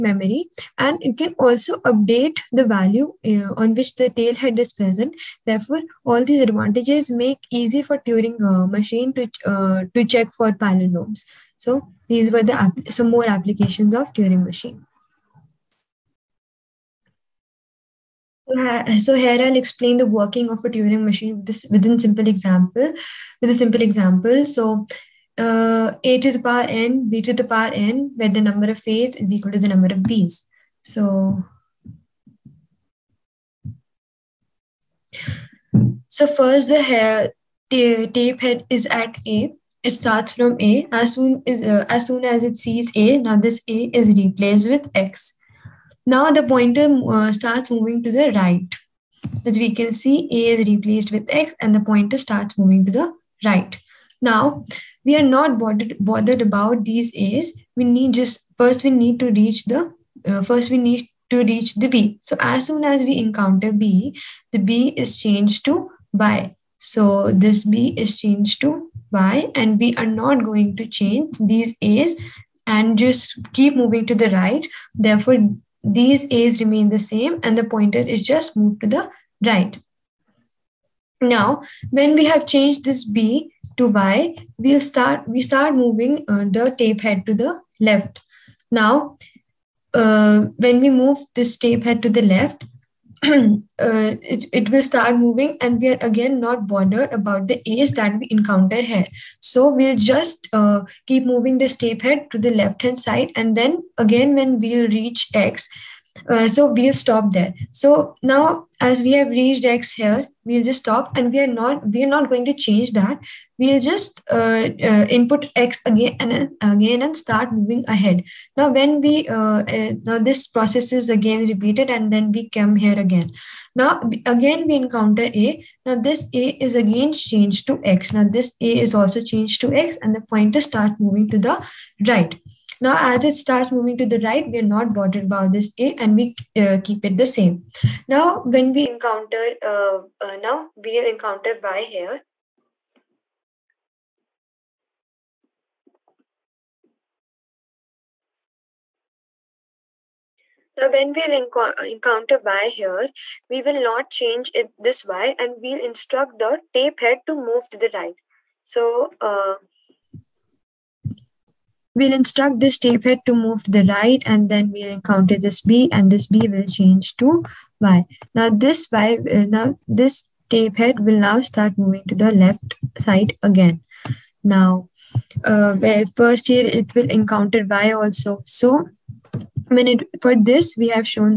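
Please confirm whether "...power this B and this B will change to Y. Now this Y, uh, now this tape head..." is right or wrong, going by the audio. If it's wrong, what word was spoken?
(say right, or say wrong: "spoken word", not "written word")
wrong: "encounter", not "power".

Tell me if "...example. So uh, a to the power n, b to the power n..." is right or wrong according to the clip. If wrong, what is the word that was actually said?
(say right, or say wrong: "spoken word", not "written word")
right.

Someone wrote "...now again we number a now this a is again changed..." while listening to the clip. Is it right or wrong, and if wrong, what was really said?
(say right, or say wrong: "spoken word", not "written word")
wrong: "encounter", not "number".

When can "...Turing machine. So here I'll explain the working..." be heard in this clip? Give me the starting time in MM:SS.
00:14.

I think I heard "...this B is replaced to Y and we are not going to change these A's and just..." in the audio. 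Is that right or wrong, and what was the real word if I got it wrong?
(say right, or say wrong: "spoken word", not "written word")
wrong: "changed", not "replaced".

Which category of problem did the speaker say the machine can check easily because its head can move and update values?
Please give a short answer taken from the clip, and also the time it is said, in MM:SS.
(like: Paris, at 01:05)
palindromes, at 00:10.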